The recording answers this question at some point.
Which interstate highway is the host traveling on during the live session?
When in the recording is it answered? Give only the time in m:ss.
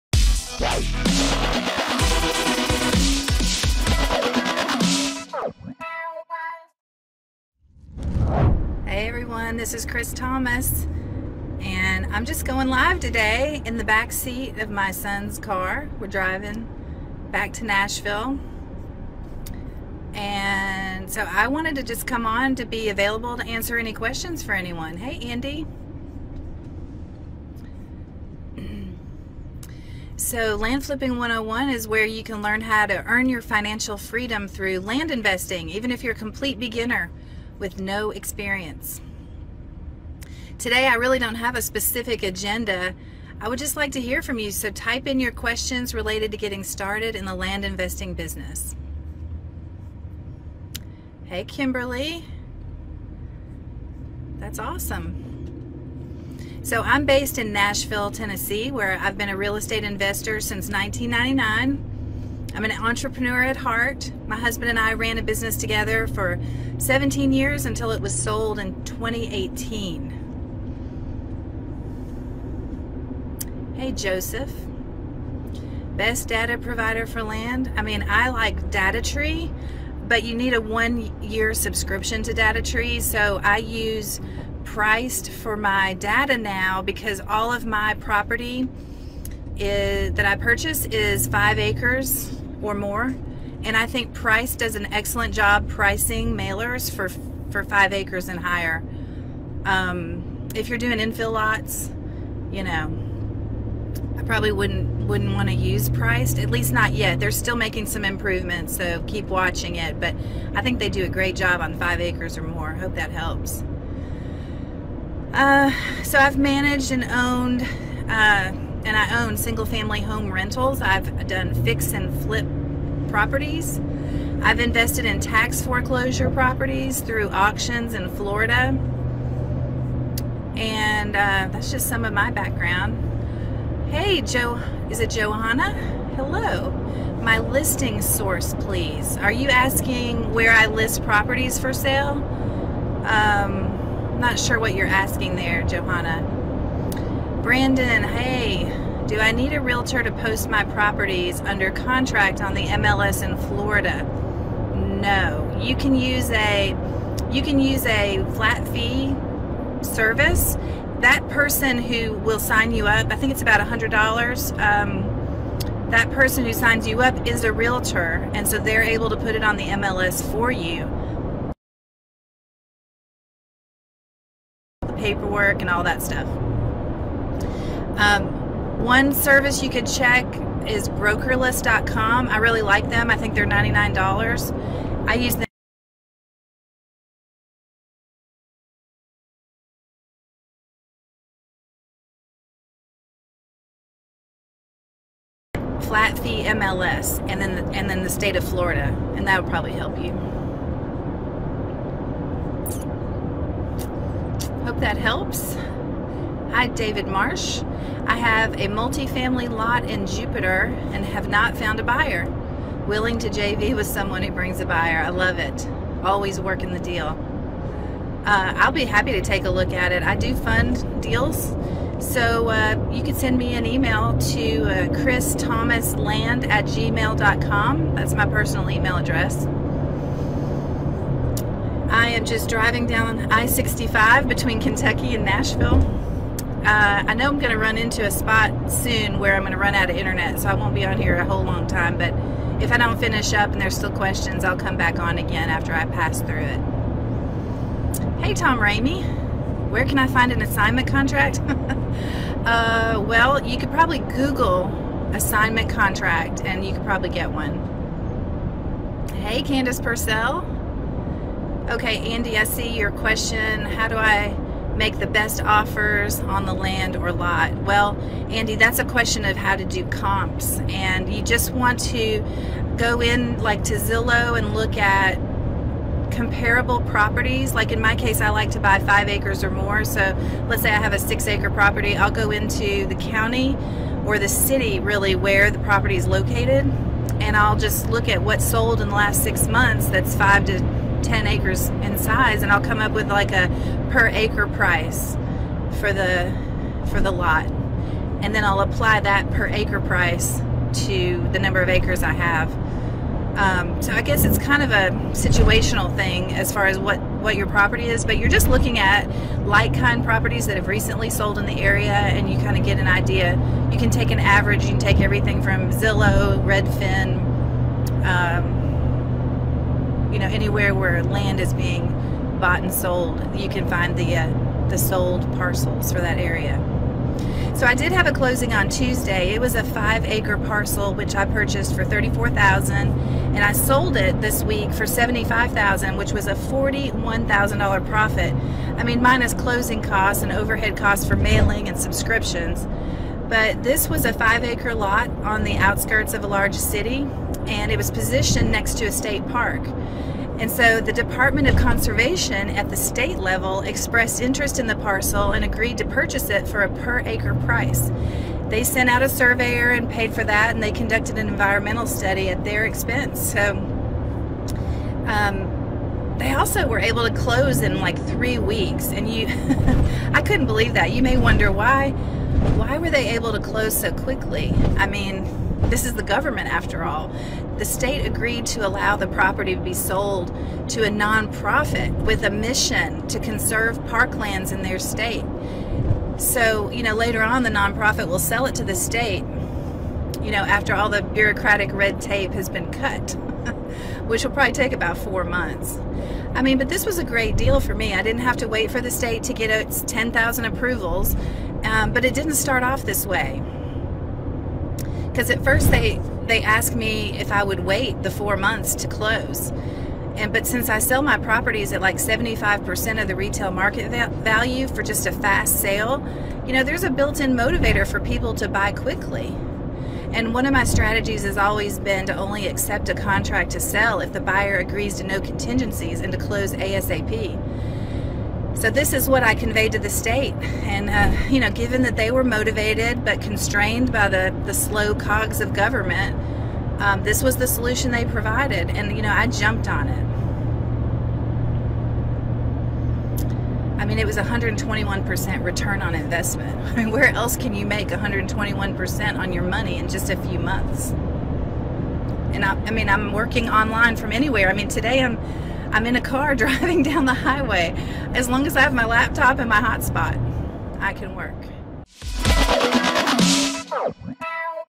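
3:53.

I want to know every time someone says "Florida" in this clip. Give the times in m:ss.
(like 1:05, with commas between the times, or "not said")
2:08, 2:33, 3:18.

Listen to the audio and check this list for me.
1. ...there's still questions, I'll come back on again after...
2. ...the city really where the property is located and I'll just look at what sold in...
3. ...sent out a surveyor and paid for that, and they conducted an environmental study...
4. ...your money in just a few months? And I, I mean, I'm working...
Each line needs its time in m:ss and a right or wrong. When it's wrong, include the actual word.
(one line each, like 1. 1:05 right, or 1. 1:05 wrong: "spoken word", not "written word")
1. 4:03 right
2. 4:44 right
3. 5:58 right
4. 7:29 right.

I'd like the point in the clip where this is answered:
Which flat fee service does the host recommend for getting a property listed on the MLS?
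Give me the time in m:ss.
3:00.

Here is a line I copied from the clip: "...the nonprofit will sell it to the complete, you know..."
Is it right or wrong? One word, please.
wrong.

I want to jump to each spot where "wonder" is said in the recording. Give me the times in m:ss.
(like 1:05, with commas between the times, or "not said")
6:11.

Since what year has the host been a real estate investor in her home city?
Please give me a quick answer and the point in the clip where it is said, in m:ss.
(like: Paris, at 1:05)
1999, at 1:00.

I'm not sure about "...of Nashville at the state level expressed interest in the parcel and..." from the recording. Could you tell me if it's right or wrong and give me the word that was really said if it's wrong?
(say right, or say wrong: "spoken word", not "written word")
wrong: "Conservation", not "Nashville".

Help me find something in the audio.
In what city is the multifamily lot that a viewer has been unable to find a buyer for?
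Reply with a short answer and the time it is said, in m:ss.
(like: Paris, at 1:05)
Jupiter, at 3:30.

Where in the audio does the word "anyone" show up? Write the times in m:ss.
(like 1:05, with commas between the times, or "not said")
0:24.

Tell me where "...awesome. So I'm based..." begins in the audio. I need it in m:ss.
0:54.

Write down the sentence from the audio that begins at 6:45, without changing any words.
Because at first they they asked me if I would wait the four months to close.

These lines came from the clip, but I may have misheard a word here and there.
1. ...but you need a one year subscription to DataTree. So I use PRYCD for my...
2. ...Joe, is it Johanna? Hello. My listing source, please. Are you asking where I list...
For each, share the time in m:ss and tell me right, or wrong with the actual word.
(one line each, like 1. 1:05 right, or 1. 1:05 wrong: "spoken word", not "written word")
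1. 1:20 right
2. 2:14 right.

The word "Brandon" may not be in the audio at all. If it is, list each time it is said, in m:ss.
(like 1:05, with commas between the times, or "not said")
2:27.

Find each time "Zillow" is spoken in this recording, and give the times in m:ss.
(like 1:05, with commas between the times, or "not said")
4:33, 5:15.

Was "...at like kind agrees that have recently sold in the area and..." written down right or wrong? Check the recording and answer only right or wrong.
wrong.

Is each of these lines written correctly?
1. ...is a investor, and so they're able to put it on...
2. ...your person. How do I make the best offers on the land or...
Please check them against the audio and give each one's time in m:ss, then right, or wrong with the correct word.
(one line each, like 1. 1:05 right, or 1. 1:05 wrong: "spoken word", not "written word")
1. 2:47 wrong: "realtor", not "investor"
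2. 4:22 wrong: "question", not "person".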